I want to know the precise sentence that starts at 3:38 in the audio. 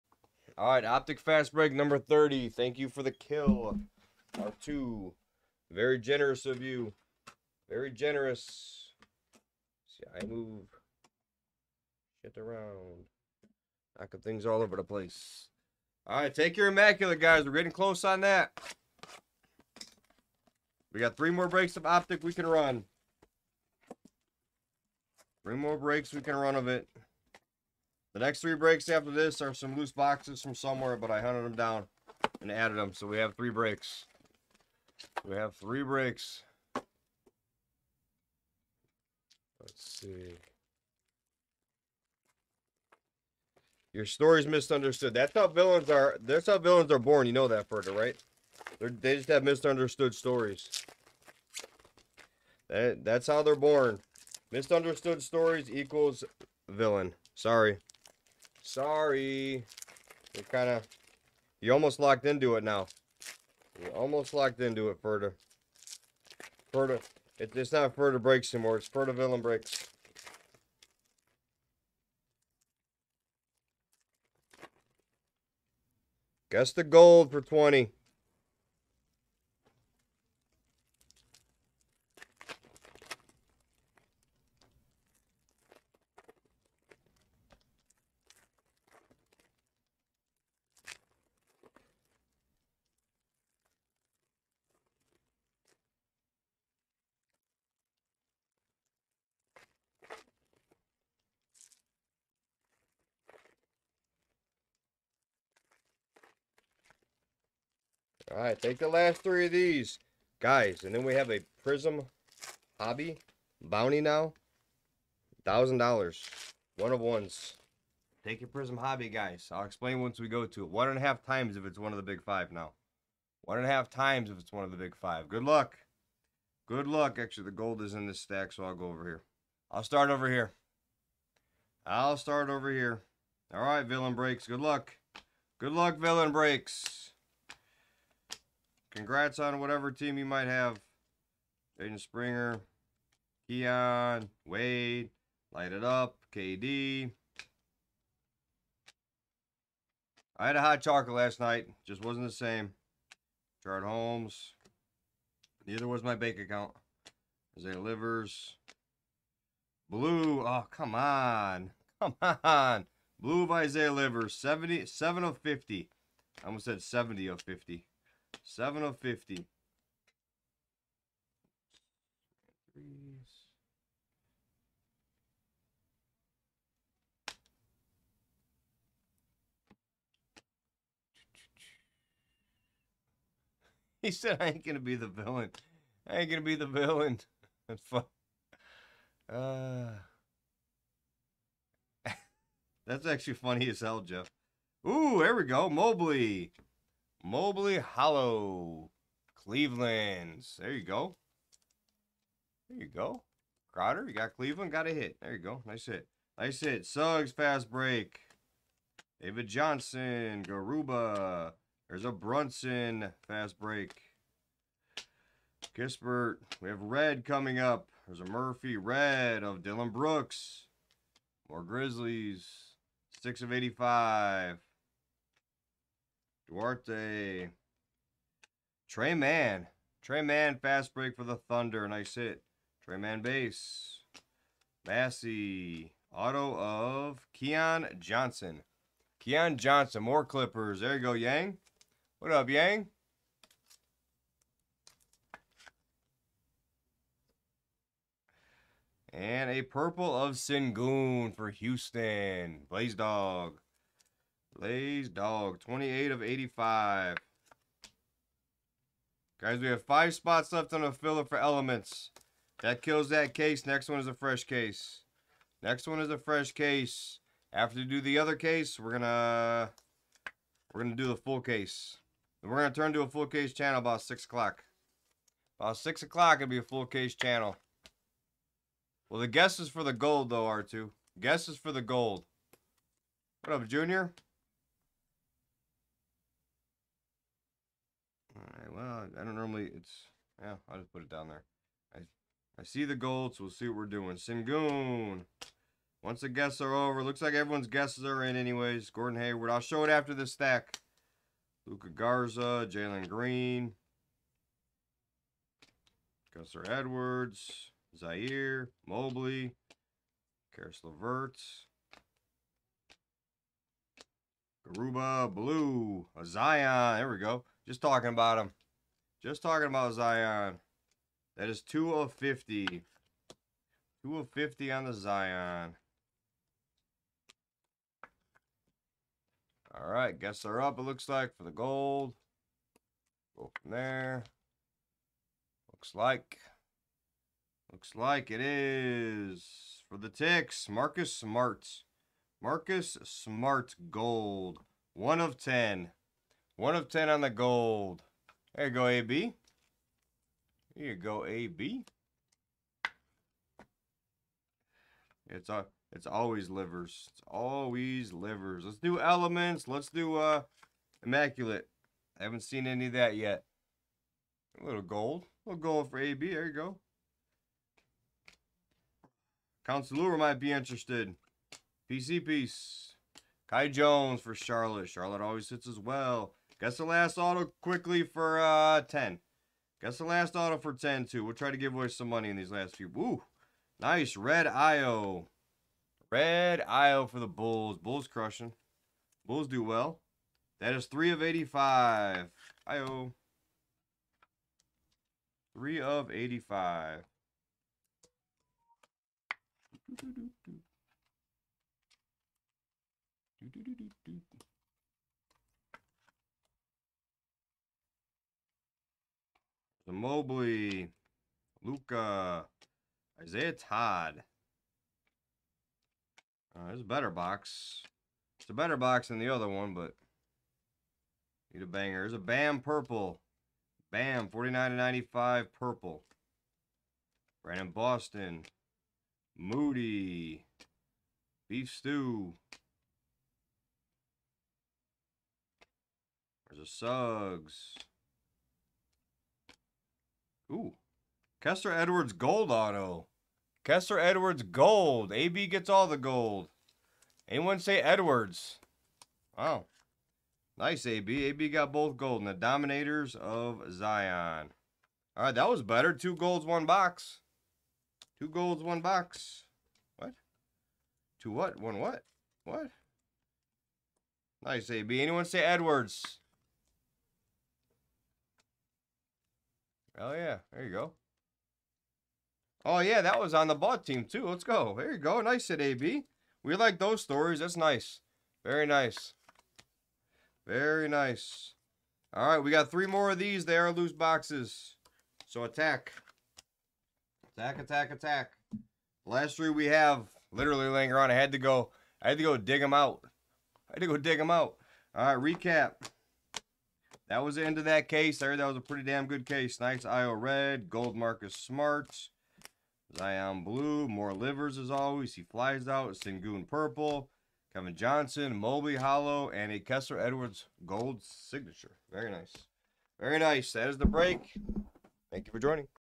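There's a Murphy, Red of Dillon Brooks.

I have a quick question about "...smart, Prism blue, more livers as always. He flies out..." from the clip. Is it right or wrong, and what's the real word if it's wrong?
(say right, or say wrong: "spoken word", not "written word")
wrong: "Zion", not "Prism".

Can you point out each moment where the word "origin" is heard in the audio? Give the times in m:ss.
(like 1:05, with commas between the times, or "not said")
not said.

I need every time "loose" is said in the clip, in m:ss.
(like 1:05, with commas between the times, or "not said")
0:29, 8:03.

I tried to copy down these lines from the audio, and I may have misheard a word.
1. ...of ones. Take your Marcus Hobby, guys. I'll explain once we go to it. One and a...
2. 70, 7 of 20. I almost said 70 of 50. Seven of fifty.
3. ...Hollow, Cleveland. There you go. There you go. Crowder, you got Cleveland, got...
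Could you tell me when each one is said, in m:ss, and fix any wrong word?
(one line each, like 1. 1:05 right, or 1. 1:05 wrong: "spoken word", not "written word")
1. 1:56 wrong: "Prism", not "Marcus"
2. 2:44 wrong: "50", not "20"
3. 3:17 right.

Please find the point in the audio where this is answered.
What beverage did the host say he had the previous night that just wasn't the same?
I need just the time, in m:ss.
2:30.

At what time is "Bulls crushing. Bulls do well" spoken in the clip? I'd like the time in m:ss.
6:27.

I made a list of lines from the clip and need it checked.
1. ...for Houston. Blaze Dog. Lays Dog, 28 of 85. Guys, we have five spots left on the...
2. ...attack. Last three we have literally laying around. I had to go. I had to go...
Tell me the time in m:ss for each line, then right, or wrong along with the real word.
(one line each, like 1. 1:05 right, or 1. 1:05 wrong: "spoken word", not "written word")
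1. 4:11 right
2. 8:07 right.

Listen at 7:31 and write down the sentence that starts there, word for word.
AB got both gold and the Dominators of Zion.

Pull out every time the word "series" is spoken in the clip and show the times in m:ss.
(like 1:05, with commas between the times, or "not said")
not said.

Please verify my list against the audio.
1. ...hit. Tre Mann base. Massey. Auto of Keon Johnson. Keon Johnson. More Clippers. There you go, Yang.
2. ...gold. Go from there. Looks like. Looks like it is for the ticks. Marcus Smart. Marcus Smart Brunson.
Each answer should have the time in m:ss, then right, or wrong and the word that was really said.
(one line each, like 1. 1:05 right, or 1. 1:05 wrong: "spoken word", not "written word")
1. 3:52 right
2. 5:31 wrong: "Gold", not "Brunson".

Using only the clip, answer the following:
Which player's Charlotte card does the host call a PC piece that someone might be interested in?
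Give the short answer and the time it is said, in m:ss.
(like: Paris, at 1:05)
Kai Jones, at 6:13.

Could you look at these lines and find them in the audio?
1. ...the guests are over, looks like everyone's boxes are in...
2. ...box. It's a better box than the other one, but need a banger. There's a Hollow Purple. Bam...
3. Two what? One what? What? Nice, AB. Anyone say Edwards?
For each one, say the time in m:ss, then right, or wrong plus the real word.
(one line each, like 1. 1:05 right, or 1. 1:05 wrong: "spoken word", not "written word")
1. 4:56 wrong: "guesses", not "boxes"
2. 6:57 wrong: "Bam", not "Hollow"
3. 7:41 right.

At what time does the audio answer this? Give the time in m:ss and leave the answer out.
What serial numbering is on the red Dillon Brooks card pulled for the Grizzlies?
3:43.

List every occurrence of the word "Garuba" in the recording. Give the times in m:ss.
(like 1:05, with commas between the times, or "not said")
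3:30, 5:14.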